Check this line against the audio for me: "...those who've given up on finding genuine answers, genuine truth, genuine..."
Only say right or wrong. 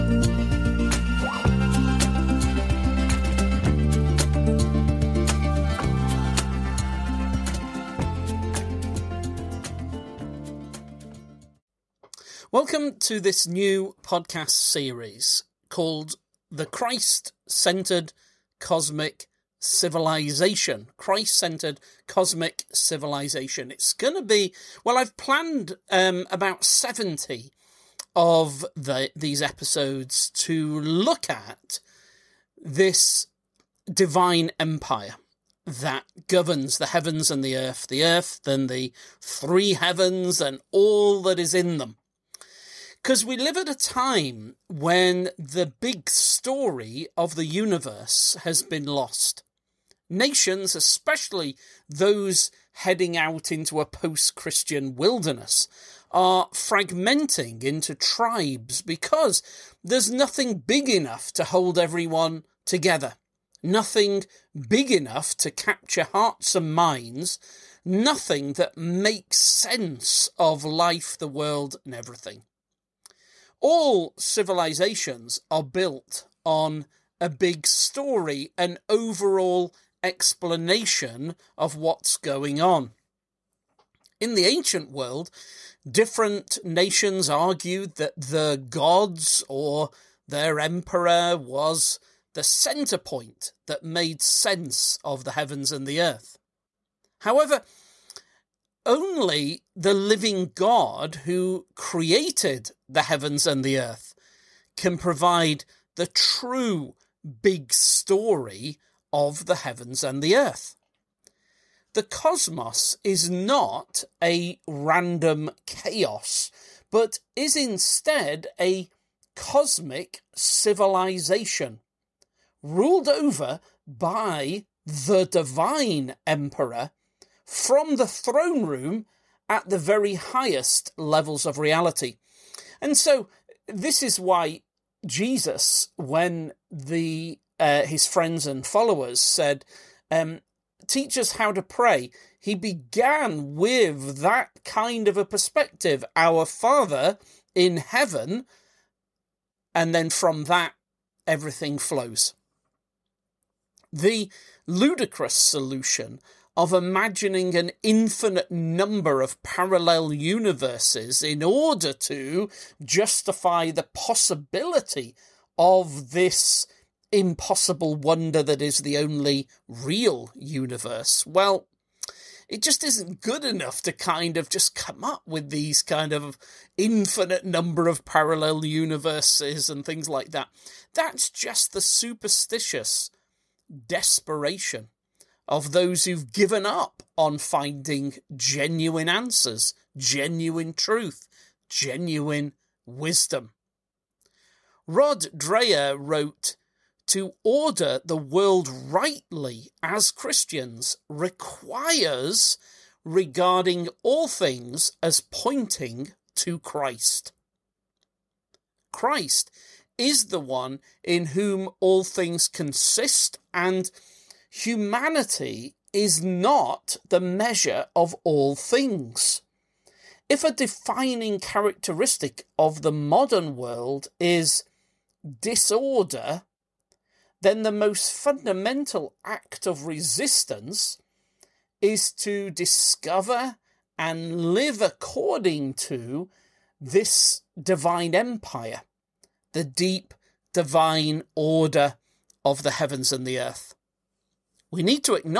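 right.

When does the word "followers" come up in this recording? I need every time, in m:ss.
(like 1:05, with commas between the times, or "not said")
2:18.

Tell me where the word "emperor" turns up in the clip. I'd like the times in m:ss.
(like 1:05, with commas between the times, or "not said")
1:30, 2:06.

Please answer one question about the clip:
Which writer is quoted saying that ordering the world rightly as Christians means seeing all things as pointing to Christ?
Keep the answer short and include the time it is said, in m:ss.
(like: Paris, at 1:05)
Rod Dreher, at 3:14.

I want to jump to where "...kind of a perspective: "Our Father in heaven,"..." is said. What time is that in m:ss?
2:24.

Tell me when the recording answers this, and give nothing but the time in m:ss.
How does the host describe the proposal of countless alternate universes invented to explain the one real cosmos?
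2:34.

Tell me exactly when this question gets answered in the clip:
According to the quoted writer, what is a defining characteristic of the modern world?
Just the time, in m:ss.
3:45.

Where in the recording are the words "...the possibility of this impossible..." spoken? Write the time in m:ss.
2:43.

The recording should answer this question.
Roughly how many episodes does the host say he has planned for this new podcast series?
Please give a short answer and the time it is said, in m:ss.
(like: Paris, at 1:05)
70, at 0:26.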